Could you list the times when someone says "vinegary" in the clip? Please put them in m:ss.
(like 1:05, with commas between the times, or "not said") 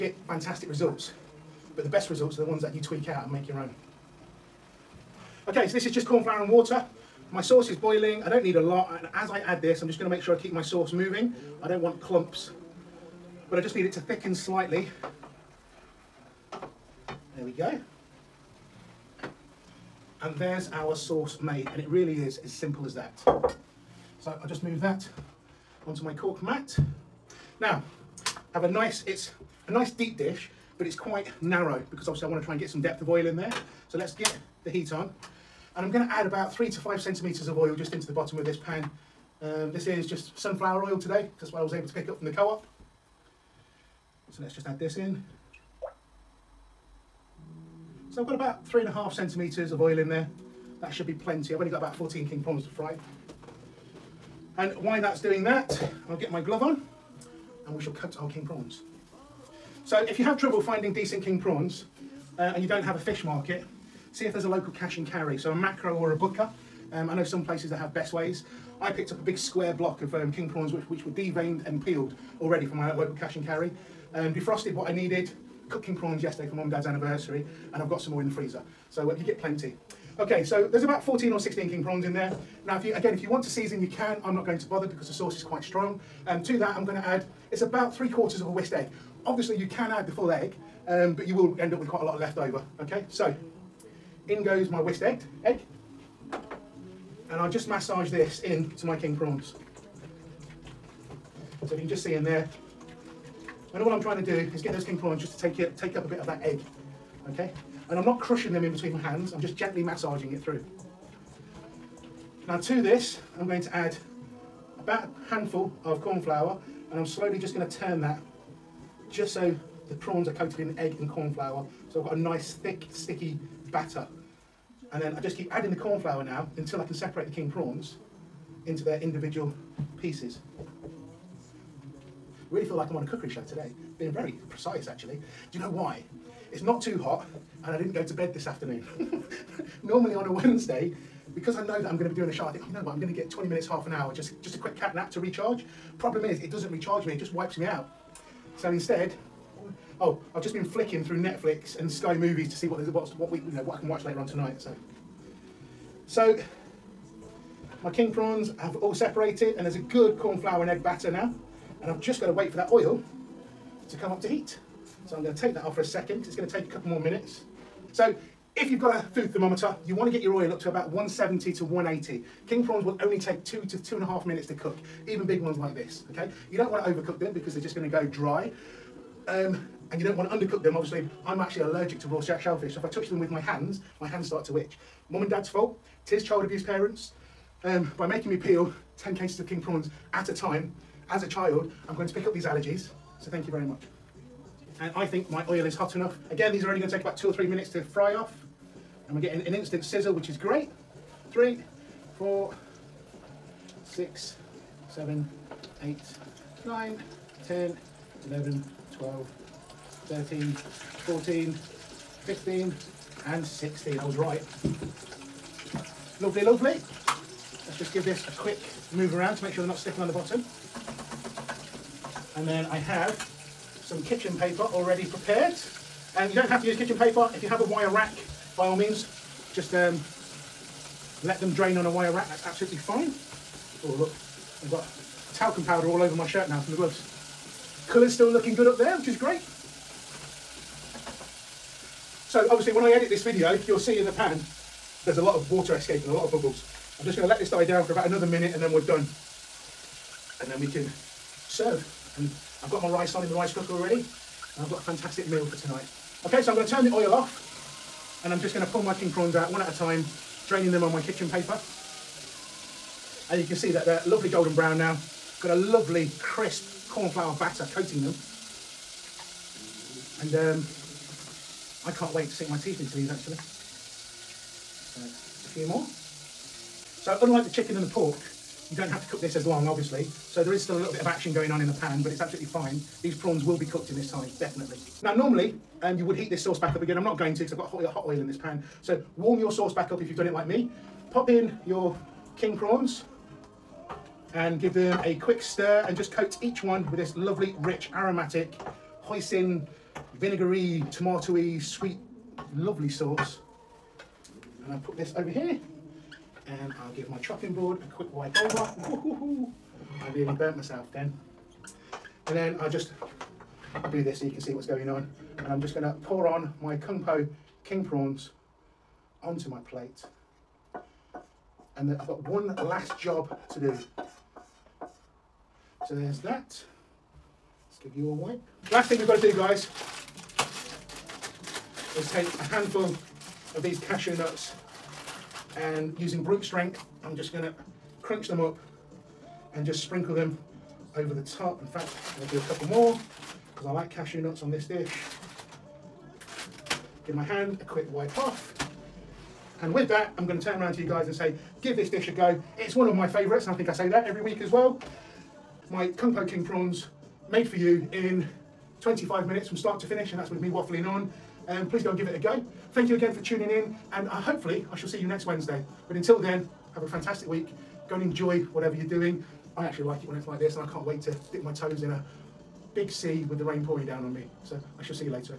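5:00.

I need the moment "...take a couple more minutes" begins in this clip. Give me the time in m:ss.
2:46.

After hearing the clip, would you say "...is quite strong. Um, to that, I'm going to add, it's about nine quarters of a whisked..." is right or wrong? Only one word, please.
wrong.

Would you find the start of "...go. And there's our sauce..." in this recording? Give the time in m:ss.
0:17.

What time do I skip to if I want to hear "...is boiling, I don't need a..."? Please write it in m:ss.
0:07.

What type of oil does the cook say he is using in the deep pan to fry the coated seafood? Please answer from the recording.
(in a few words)
sunflower oil.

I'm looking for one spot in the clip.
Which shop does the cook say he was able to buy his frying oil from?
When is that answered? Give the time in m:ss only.
0:42.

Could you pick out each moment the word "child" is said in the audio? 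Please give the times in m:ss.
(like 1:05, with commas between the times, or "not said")
3:06, 3:11.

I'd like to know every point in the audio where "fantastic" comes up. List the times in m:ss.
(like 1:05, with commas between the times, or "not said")
0:00, 4:14, 6:06.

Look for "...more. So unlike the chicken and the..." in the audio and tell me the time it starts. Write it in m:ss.
4:35.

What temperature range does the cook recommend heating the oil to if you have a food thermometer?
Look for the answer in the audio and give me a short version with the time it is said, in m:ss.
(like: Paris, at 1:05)
170 to 180, at 2:50.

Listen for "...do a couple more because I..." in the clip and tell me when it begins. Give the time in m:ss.
5:42.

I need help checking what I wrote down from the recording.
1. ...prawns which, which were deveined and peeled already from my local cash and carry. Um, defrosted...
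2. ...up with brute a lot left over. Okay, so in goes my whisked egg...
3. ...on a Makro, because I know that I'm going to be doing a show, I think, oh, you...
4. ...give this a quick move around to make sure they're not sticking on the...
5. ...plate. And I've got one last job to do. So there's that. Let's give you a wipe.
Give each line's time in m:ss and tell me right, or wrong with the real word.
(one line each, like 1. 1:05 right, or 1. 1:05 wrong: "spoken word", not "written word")
1. 1:10 right
2. 1:31 wrong: "quite", not "brute"
3. 2:20 wrong: "Wednesday", not "Makro"
4. 3:37 right
5. 5:19 right.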